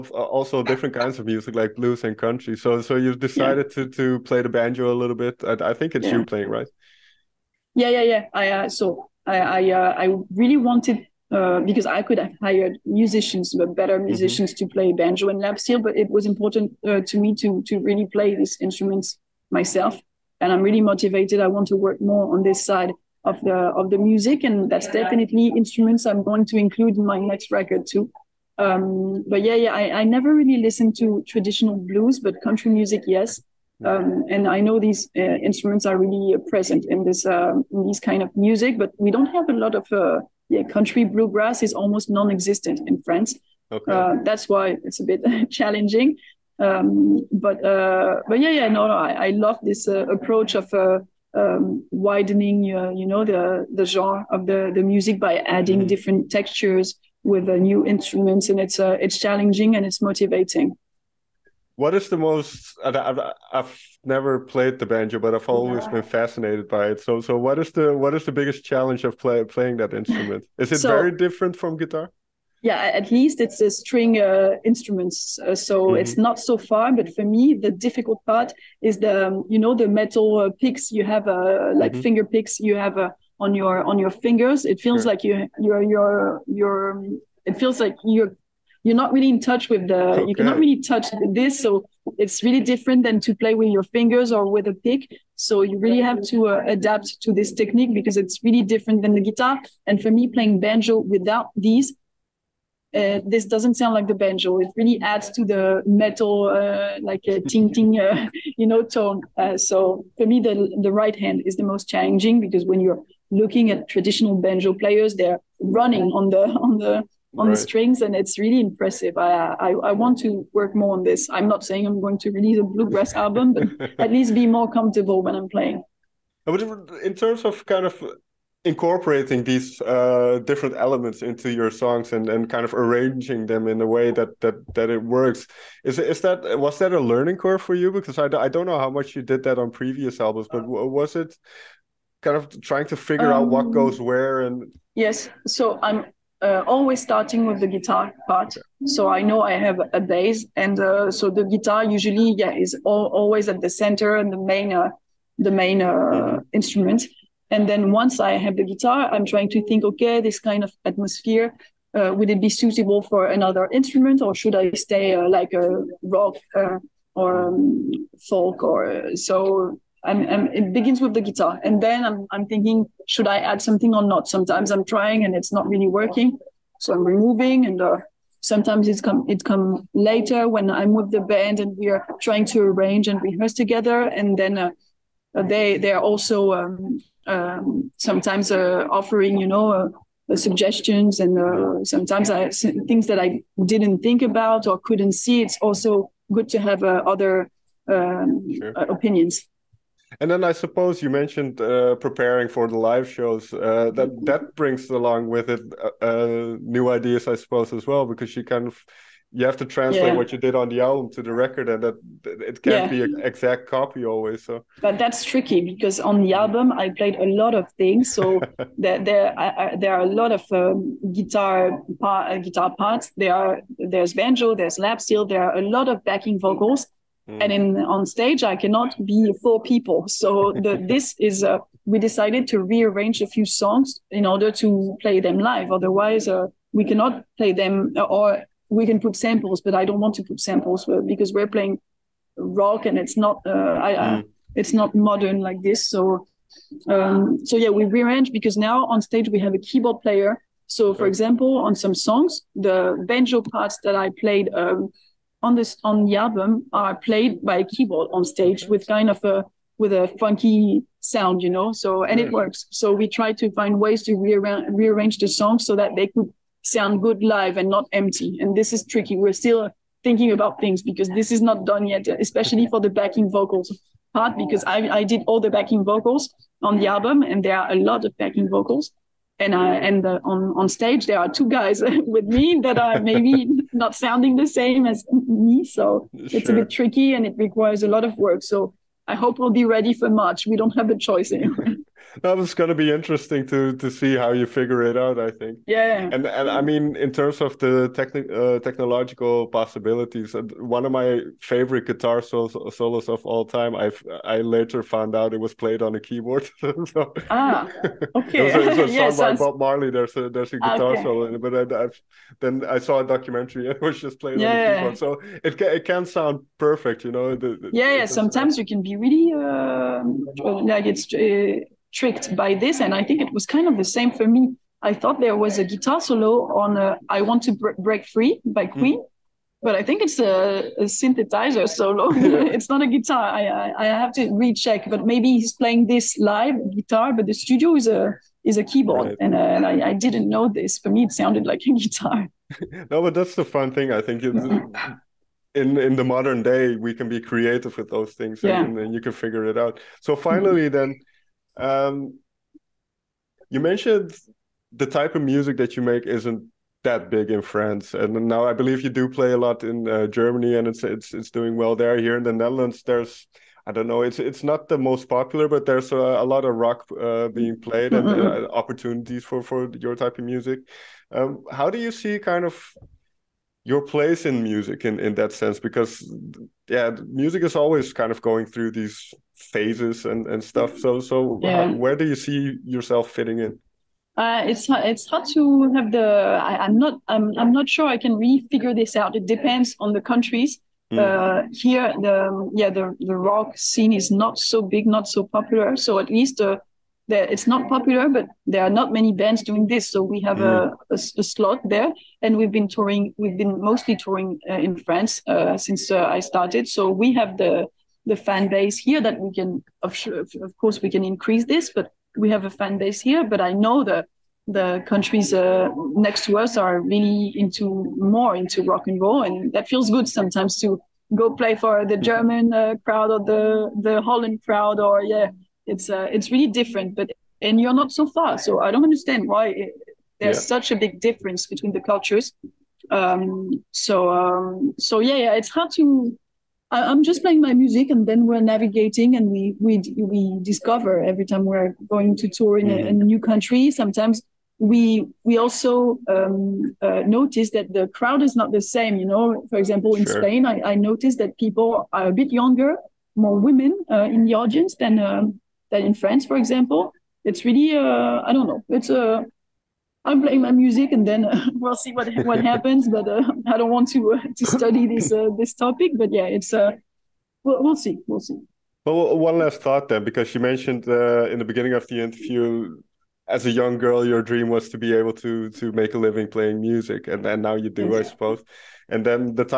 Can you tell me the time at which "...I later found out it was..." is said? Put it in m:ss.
5:04.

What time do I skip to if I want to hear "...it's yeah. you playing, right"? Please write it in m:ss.
0:05.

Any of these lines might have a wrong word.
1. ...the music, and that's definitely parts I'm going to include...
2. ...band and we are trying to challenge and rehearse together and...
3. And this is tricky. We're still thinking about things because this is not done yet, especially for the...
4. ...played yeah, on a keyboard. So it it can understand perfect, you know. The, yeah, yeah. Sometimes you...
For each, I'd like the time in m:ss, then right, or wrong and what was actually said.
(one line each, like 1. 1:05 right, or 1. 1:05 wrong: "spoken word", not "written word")
1. 0:23 wrong: "instruments", not "parts"
2. 3:01 wrong: "arrange", not "challenge"
3. 4:28 right
4. 5:14 wrong: "sound", not "understand".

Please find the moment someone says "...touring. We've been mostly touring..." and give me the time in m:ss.
6:42.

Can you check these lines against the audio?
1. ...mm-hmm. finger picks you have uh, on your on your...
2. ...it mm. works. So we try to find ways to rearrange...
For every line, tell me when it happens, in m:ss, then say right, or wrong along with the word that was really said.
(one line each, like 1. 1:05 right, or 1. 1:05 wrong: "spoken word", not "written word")
1. 1:21 right
2. 4:22 right.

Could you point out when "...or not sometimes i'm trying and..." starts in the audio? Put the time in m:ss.
2:53.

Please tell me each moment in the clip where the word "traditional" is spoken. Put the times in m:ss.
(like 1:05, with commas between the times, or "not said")
0:31, 1:53.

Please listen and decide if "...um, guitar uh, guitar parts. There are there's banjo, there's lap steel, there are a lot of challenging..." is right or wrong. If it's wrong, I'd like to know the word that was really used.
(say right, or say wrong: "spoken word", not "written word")
wrong: "backing", not "challenging".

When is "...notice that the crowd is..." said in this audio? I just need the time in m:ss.
7:27.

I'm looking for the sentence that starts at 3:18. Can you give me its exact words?
opinions and then I suppose you mentioned uh, preparing for the live shows.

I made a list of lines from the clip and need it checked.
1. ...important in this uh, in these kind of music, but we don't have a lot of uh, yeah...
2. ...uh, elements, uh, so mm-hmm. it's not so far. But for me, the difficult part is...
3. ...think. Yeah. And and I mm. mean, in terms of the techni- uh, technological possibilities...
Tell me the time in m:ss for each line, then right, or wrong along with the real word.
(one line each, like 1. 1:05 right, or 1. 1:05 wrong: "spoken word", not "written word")
1. 0:36 wrong: "present", not "important"
2. 1:14 wrong: "instruments", not "elements"
3. 4:55 right.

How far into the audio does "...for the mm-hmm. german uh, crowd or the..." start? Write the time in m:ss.
7:01.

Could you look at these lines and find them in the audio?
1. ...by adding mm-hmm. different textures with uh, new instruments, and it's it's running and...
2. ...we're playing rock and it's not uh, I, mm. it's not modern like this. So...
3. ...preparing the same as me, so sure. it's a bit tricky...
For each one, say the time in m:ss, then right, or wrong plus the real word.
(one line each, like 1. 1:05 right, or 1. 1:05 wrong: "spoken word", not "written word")
1. 0:55 wrong: "challenging", not "running"
2. 4:01 right
3. 4:43 wrong: "sounding", not "preparing".